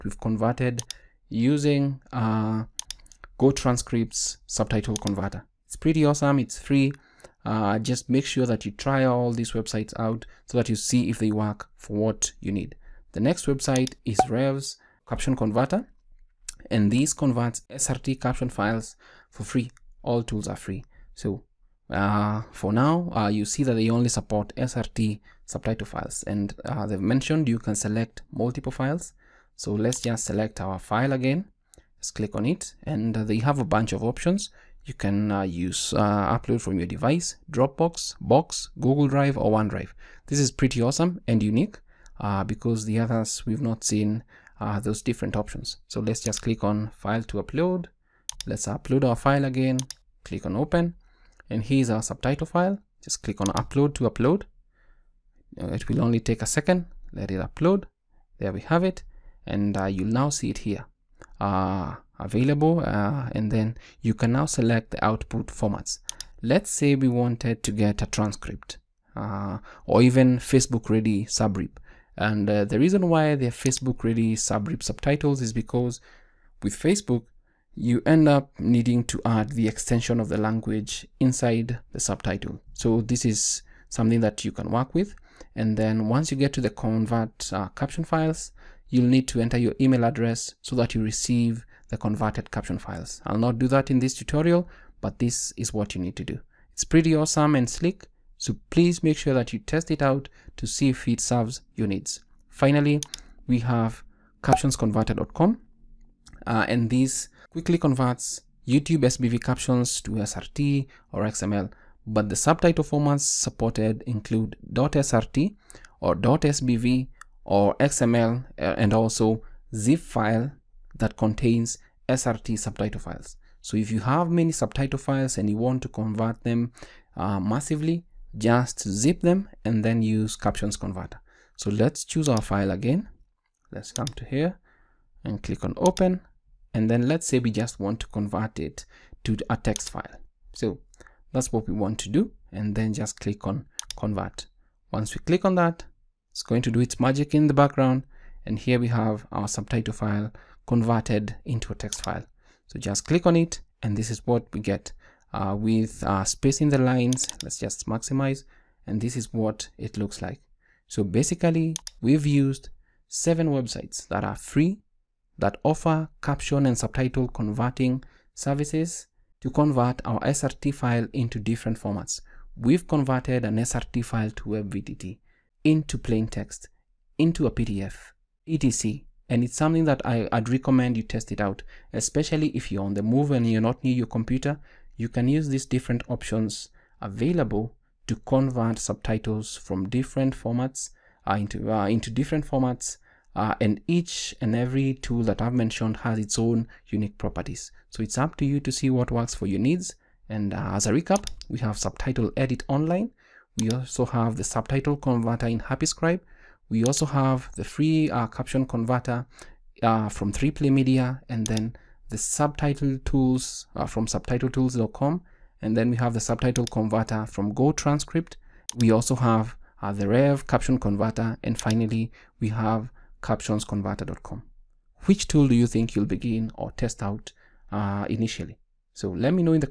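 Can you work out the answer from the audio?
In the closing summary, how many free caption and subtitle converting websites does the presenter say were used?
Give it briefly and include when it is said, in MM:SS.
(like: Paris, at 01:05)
7, at 02:43.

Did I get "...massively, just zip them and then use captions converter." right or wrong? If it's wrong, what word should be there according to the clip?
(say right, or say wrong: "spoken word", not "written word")
right.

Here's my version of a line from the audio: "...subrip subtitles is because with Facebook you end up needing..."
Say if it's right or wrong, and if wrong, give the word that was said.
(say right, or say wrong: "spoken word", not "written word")
right.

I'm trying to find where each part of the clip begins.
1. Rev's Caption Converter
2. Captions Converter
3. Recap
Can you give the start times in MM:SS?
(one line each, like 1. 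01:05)
1. 00:13
2. 01:43
3. 03:20.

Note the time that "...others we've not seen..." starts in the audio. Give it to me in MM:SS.
00:42.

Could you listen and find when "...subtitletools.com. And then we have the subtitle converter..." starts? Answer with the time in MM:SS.
03:34.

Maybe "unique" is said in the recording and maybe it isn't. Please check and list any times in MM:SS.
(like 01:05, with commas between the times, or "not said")
00:41, 03:16.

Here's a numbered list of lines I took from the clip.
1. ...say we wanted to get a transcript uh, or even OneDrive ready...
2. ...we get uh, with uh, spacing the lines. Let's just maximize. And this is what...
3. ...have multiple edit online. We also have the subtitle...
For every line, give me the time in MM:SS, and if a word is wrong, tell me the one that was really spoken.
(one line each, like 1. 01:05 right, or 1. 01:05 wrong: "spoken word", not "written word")
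1. 01:06 wrong: "Facebook", not "OneDrive"
2. 02:34 right
3. 03:21 wrong: "subtitle", not "multiple".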